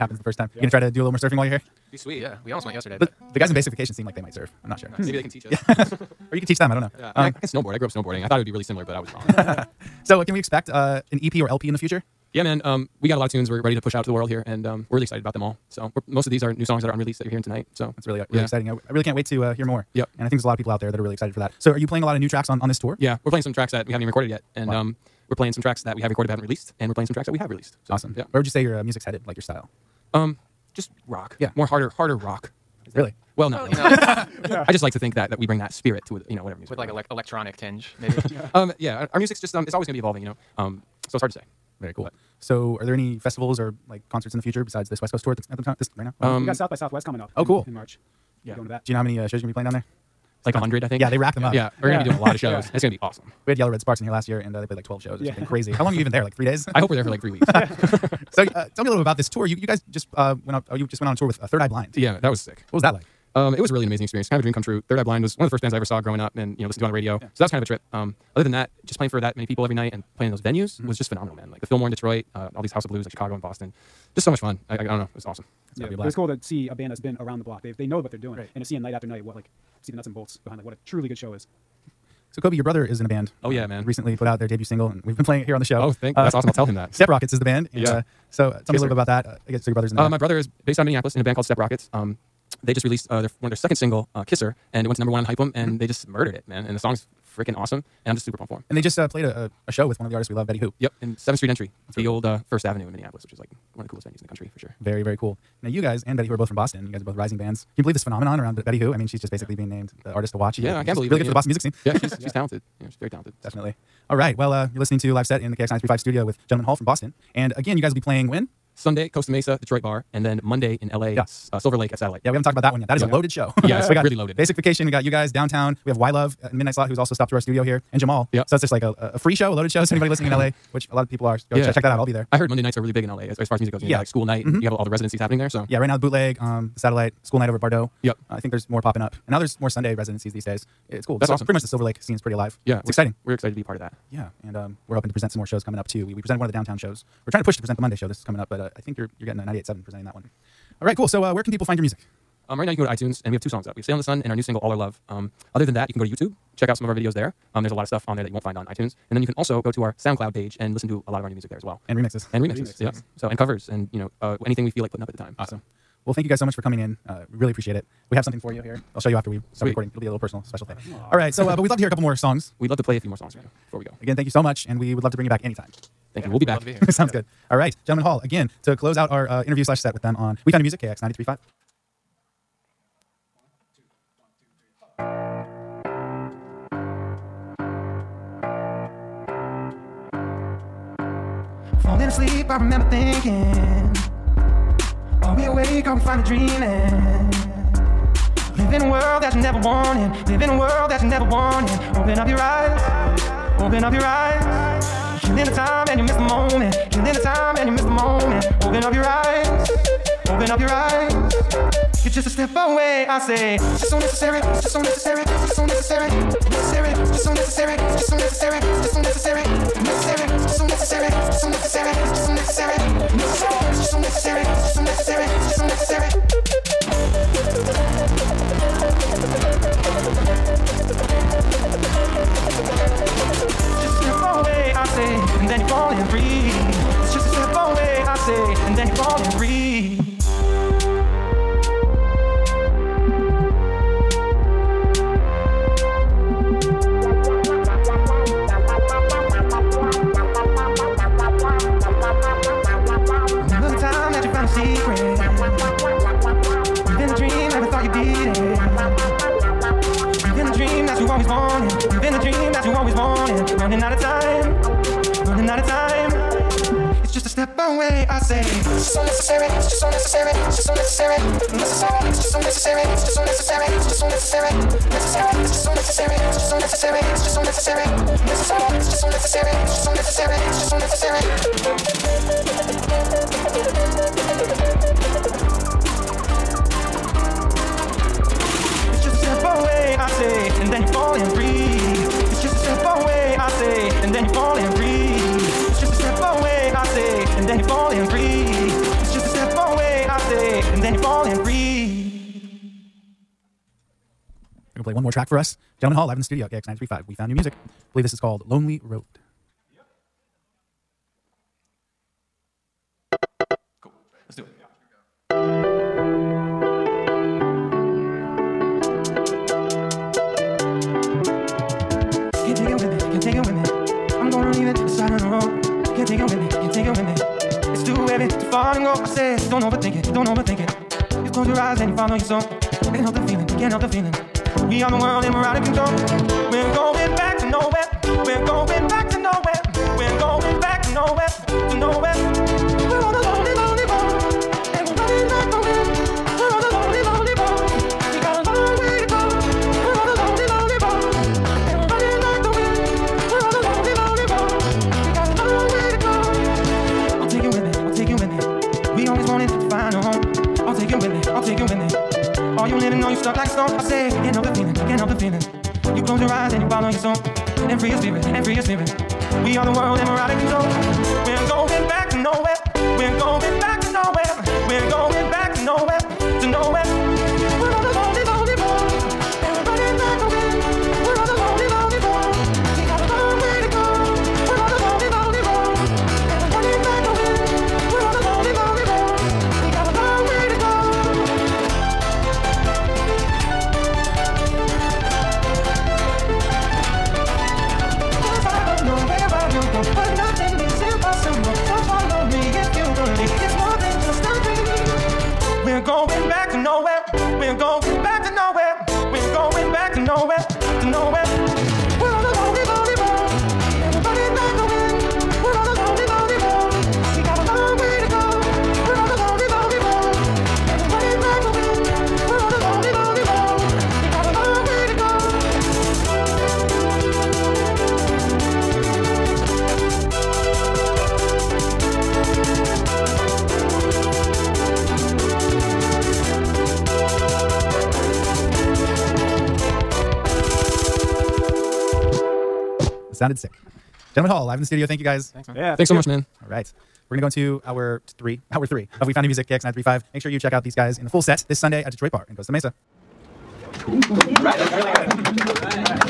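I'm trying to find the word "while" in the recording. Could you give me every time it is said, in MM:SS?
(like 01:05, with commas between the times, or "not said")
00:01.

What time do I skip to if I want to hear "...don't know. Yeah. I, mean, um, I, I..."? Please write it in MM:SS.
00:06.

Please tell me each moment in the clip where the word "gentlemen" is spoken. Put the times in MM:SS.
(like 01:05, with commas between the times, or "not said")
01:56, 02:57, 05:05, 07:24.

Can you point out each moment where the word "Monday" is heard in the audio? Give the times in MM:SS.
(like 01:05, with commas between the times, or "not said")
02:00, 02:12, 02:27.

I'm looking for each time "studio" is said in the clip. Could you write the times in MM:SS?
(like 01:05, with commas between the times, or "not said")
01:55, 02:07, 05:06, 07:24.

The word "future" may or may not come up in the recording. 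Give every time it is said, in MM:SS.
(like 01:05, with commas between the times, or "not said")
00:11, 00:44.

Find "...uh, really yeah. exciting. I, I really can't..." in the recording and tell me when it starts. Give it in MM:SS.
00:18.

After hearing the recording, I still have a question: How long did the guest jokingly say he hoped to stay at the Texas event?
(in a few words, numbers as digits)
3 weeks.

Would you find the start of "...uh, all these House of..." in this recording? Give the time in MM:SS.
01:12.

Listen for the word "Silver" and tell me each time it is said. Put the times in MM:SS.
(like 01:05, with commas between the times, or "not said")
02:01, 02:21.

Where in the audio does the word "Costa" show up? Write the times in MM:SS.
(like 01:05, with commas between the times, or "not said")
01:59, 07:32.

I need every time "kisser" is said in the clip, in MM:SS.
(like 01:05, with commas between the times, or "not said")
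01:28, 01:34.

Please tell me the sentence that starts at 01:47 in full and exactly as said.
Can you believe this phenomenon around Betty Who?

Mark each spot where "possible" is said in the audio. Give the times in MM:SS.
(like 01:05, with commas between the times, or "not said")
not said.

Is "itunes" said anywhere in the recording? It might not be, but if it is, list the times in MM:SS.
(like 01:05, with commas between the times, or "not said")
02:32, 02:38.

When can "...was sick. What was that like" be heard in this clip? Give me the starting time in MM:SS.
01:02.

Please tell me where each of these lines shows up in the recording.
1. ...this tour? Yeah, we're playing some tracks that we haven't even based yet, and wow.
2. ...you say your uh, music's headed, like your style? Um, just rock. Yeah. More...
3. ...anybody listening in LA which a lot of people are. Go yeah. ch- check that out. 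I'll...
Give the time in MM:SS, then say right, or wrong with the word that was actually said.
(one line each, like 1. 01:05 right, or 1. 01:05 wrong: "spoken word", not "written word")
1. 00:22 wrong: "recorded", not "based"
2. 00:28 right
3. 02:09 right.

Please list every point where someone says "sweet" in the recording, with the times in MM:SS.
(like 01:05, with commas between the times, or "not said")
00:01, 02:49.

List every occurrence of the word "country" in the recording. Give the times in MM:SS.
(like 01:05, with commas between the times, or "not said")
01:44.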